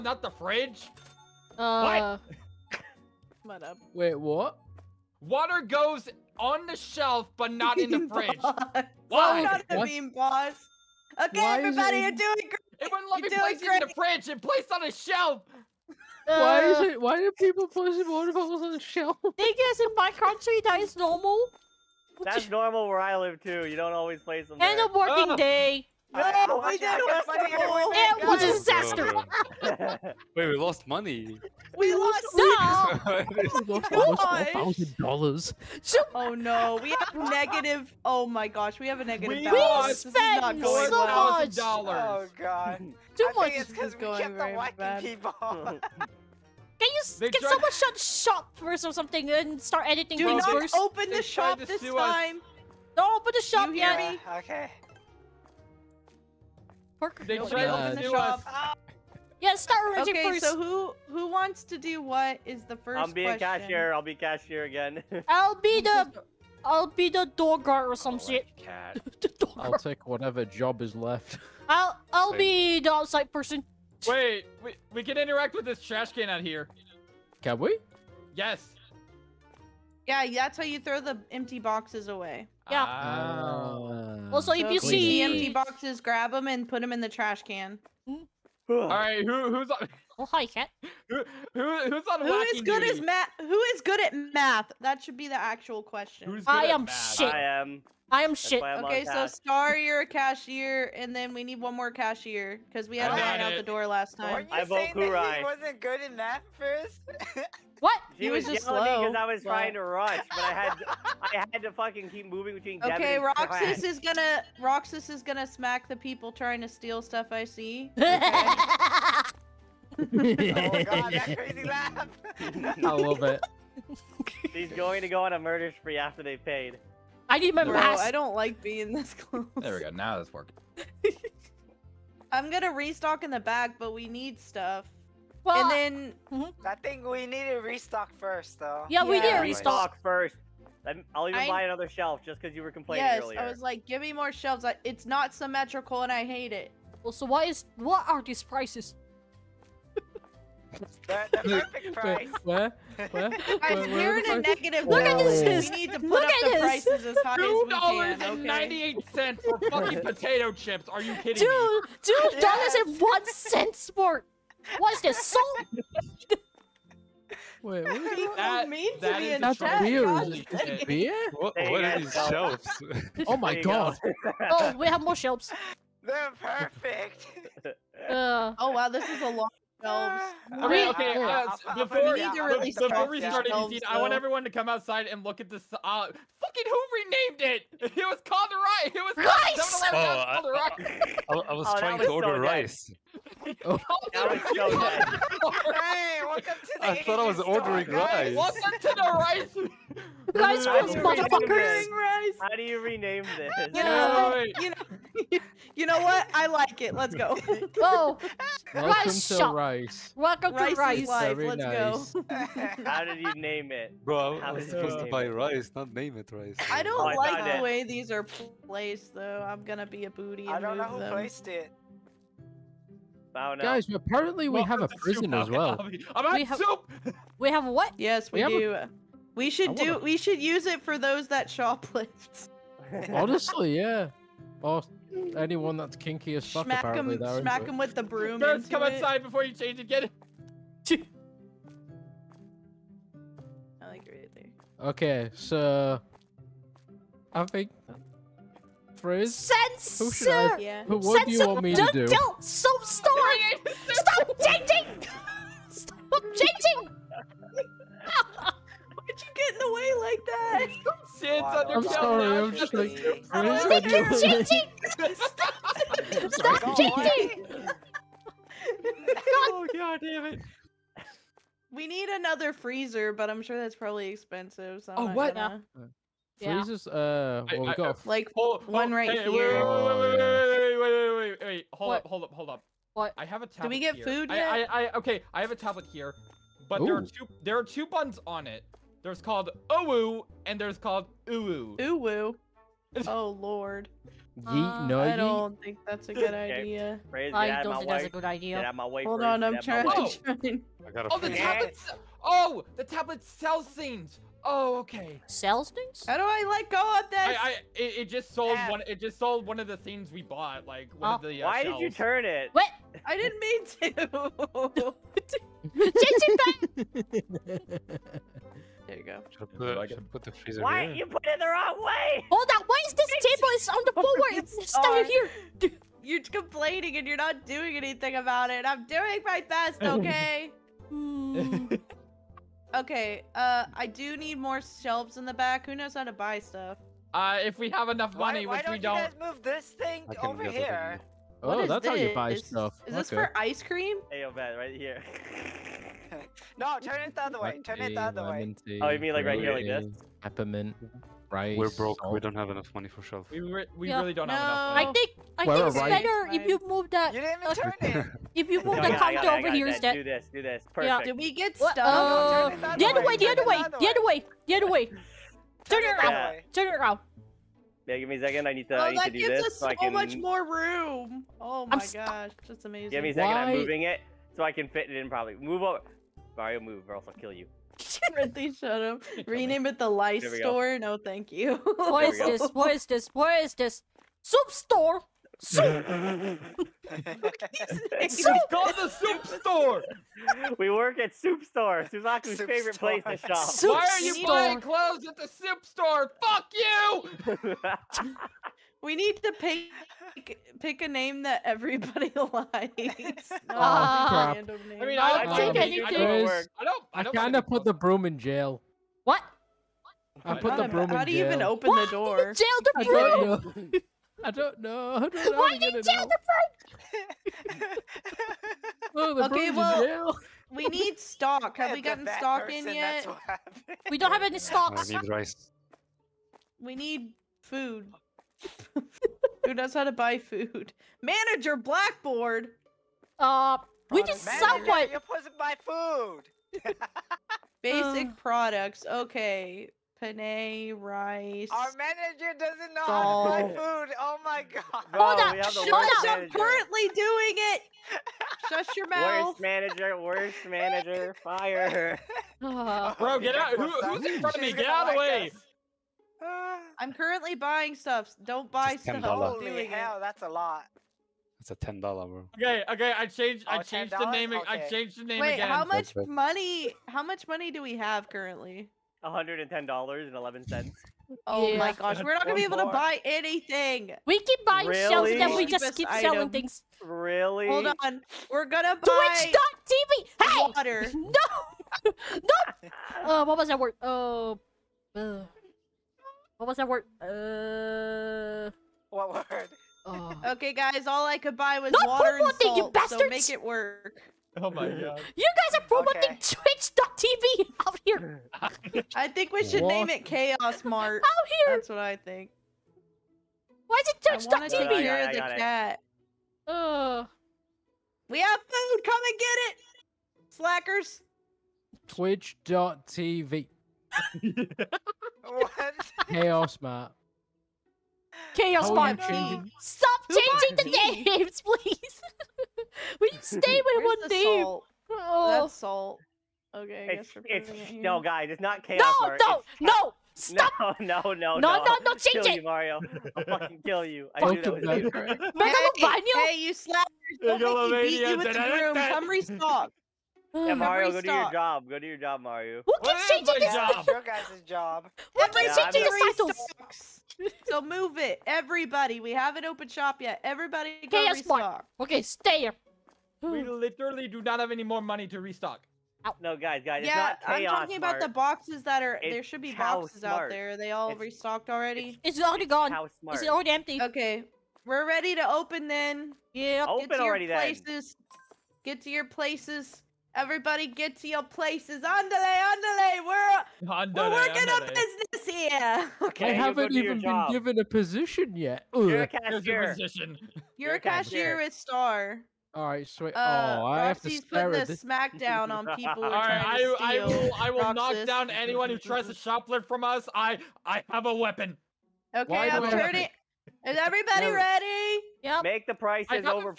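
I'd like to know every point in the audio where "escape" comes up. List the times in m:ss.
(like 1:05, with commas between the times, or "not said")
not said.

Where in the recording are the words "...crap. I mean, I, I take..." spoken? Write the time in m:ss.
6:43.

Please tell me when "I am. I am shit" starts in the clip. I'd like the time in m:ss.
1:37.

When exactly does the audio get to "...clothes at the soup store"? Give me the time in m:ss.
6:34.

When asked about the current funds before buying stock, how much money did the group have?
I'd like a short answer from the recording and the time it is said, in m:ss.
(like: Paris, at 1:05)
$110.11, at 7:49.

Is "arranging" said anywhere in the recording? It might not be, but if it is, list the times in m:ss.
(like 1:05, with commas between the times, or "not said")
0:59.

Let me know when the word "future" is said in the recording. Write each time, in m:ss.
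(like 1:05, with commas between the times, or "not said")
not said.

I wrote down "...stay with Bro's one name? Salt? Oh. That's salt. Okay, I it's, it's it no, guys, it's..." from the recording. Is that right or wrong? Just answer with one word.
wrong.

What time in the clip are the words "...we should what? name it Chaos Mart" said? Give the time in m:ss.
8:19.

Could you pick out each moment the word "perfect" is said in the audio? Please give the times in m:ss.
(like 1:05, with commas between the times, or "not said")
2:31, 2:56, 6:00.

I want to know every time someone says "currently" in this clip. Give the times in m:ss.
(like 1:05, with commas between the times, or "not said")
7:26, 7:36, 7:48.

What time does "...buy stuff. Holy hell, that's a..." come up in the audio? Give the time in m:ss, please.
7:38.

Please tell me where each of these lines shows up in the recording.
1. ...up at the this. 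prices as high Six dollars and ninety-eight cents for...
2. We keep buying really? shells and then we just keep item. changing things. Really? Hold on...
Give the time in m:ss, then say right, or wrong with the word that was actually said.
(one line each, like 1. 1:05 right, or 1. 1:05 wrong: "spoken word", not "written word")
1. 2:36 wrong: "Two", not "Six"
2. 7:54 wrong: "selling", not "changing".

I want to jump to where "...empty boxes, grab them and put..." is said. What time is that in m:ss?
1:25.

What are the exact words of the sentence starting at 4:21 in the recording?
under I'm sorry, I'm just like...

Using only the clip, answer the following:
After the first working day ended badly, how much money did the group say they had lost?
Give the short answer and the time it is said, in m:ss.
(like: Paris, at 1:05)
$4,000, at 0:34.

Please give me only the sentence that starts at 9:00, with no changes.
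Yeah, Mario, go to your job.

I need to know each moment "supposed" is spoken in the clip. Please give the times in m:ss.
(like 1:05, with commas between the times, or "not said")
3:34, 7:15.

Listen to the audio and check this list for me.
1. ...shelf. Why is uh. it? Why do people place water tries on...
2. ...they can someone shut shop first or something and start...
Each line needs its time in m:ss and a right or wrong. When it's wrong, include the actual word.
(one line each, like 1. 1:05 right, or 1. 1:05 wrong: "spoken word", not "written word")
1. 0:14 wrong: "bottles", not "tries"
2. 0:47 right.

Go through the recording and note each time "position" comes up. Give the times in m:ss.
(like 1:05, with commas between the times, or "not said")
9:37.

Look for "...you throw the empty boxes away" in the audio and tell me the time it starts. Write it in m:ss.
1:20.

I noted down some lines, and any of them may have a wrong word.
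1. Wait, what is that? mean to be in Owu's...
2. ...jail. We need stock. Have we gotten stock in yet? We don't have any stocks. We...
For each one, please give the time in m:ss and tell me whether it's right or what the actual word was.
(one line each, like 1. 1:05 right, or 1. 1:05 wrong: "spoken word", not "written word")
1. 2:47 wrong: "That", not "Owu"
2. 6:59 right.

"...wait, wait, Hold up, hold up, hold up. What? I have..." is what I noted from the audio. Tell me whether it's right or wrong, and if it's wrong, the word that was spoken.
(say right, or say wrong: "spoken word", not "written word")
right.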